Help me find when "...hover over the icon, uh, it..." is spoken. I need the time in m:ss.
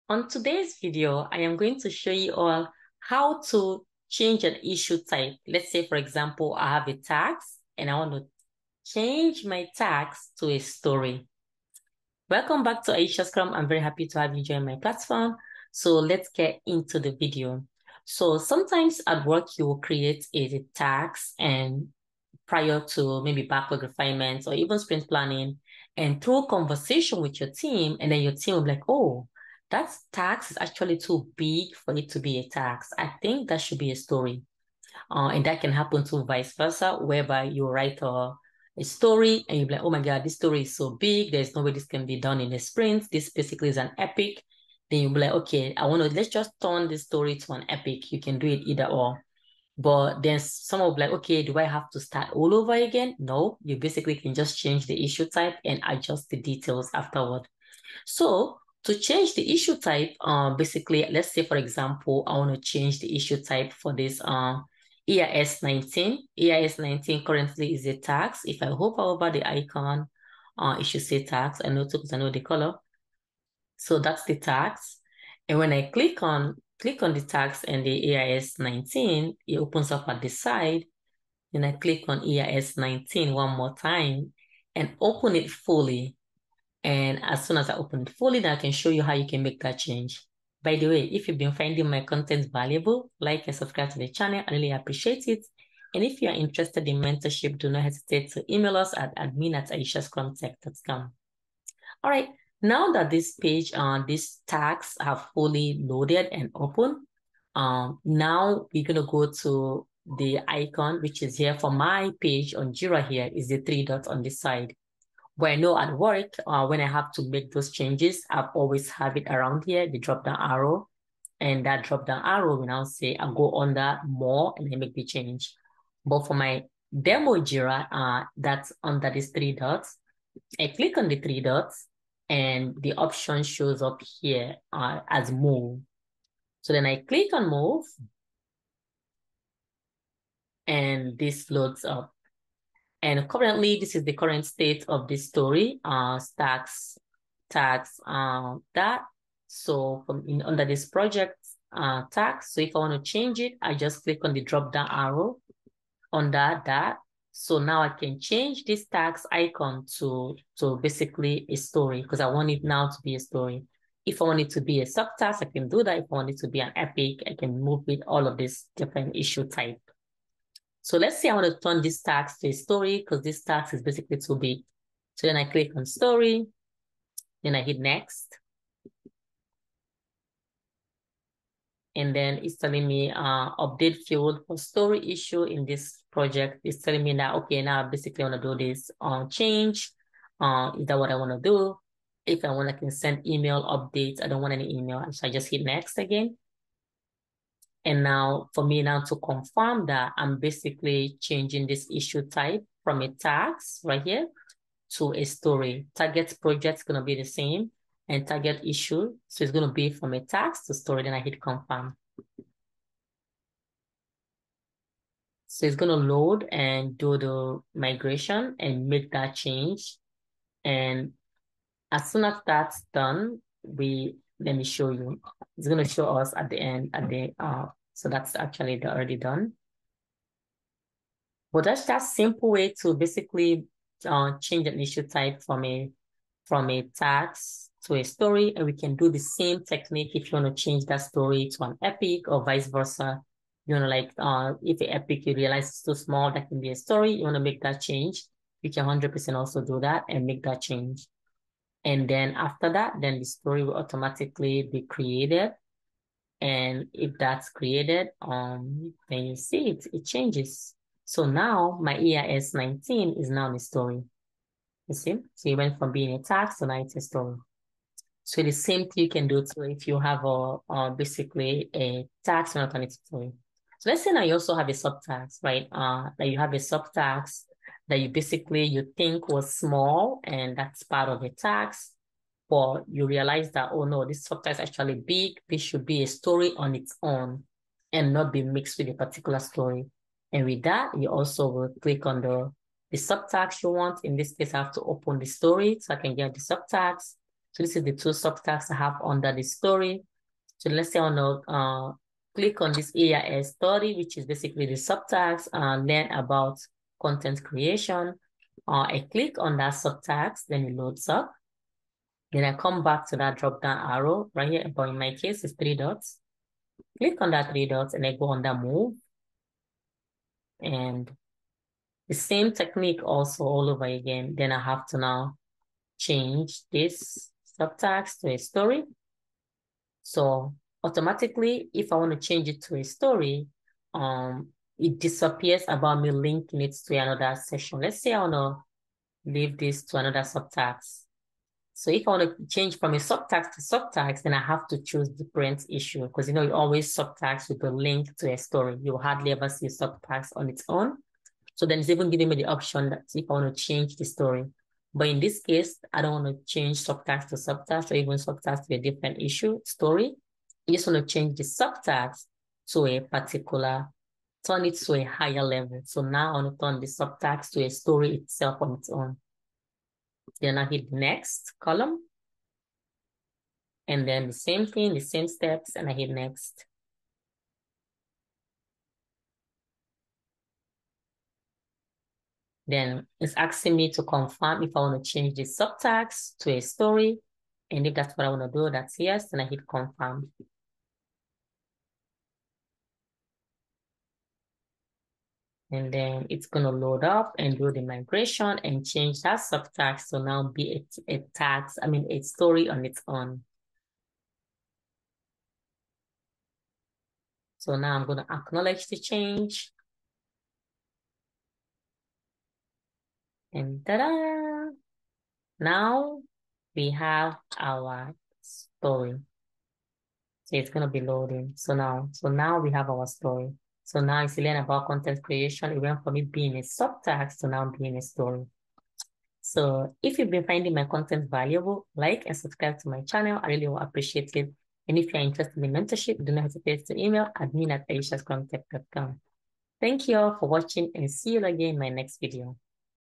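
1:08.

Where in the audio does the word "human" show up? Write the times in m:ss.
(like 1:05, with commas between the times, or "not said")
not said.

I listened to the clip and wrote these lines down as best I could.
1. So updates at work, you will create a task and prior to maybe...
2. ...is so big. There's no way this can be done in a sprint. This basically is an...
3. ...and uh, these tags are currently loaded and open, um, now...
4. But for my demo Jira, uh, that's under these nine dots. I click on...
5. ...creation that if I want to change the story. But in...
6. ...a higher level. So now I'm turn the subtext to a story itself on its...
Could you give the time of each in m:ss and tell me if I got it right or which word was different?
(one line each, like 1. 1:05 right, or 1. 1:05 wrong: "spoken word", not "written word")
1. 0:18 wrong: "sometimes", not "updates"
2. 0:40 right
3. 1:43 wrong: "fully", not "currently"
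4. 2:06 wrong: "three", not "nine"
5. 5:52 wrong: "option", not "creation"
6. 6:04 right.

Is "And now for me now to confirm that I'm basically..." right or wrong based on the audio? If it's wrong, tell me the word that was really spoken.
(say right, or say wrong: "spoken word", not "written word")
right.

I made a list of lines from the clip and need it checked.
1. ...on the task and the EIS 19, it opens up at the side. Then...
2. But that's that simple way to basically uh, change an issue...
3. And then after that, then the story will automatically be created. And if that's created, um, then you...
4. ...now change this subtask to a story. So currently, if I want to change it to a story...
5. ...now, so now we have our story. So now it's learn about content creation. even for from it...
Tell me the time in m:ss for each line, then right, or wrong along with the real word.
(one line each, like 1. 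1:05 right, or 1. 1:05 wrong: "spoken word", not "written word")
1. 1:17 right
2. 3:51 right
3. 4:11 right
4. 5:24 wrong: "automatically", not "currently"
5. 7:01 right.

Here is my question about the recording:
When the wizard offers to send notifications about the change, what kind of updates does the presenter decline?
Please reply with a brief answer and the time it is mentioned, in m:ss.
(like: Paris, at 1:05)
email updates, at 3:13.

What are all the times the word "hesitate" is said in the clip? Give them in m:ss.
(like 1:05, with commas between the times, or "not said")
1:37, 7:16.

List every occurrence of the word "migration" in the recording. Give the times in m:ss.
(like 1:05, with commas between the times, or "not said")
3:37, 6:37.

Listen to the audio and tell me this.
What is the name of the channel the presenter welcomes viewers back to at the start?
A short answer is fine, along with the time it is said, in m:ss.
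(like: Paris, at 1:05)
Aisha Scrum, at 0:12.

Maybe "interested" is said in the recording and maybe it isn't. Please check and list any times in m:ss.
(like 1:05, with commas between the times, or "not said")
1:36, 7:15.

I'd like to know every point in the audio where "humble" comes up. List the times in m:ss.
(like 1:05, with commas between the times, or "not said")
not said.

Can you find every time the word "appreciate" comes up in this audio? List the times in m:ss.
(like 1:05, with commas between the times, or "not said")
1:34, 7:13.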